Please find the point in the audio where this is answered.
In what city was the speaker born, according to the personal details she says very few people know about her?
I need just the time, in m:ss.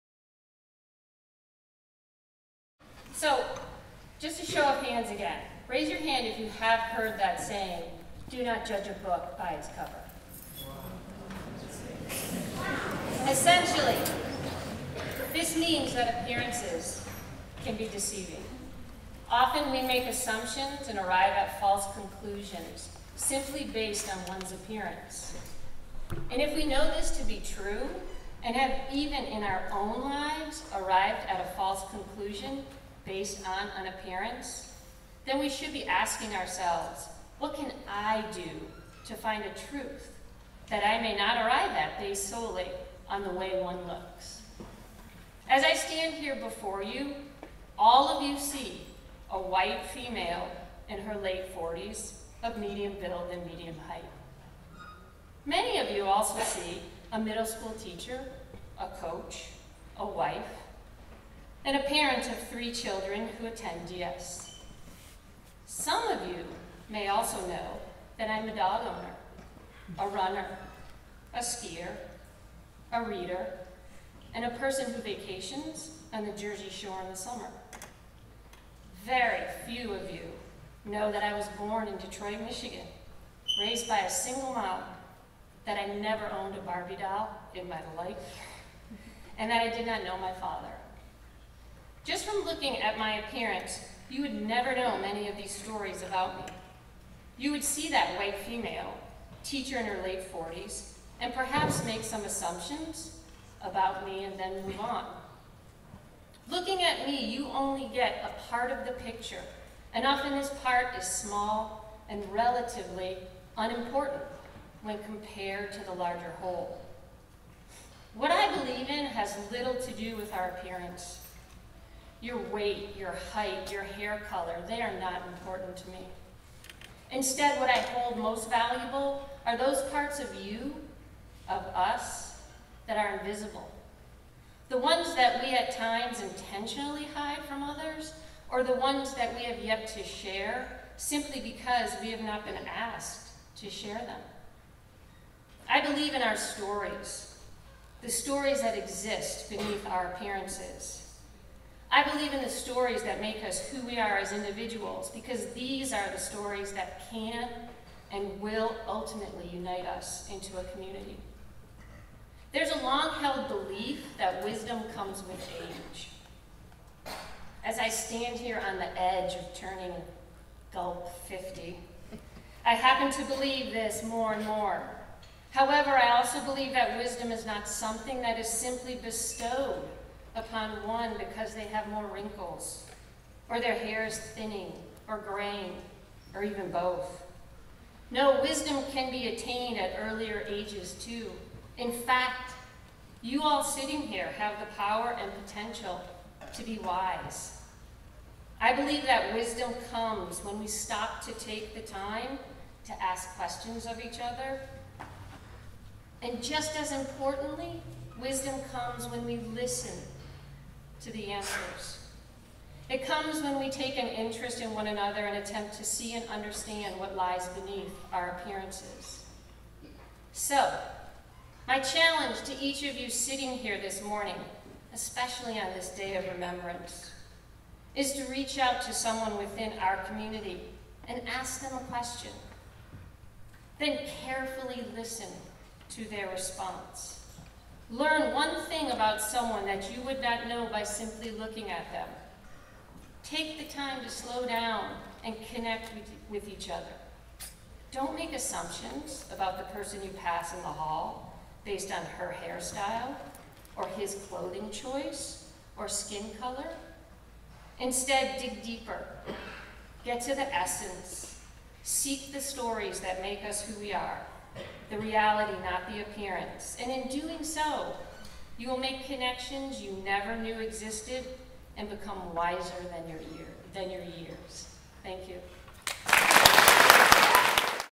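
1:21.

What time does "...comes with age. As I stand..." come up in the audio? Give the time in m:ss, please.
2:44.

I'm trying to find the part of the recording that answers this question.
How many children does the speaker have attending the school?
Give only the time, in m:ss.
1:02.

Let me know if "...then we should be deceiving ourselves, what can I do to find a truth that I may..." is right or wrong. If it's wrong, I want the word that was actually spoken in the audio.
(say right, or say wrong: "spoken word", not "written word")
wrong: "asking", not "deceiving".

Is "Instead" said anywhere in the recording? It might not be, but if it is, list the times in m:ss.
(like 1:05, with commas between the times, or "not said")
2:07, 4:17.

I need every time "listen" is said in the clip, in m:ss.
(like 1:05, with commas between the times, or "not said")
3:29, 3:54.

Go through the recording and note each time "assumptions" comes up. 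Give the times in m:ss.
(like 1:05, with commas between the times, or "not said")
0:20, 1:42, 4:08.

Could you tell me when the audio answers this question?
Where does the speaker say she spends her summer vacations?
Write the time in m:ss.
1:16.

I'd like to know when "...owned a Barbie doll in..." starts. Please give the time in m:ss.
1:26.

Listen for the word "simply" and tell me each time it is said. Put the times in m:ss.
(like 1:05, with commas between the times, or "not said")
0:23, 2:20, 2:58, 4:00.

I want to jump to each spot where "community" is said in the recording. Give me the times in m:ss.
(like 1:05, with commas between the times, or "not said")
2:40, 3:50.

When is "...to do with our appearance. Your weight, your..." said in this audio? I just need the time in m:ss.
1:59.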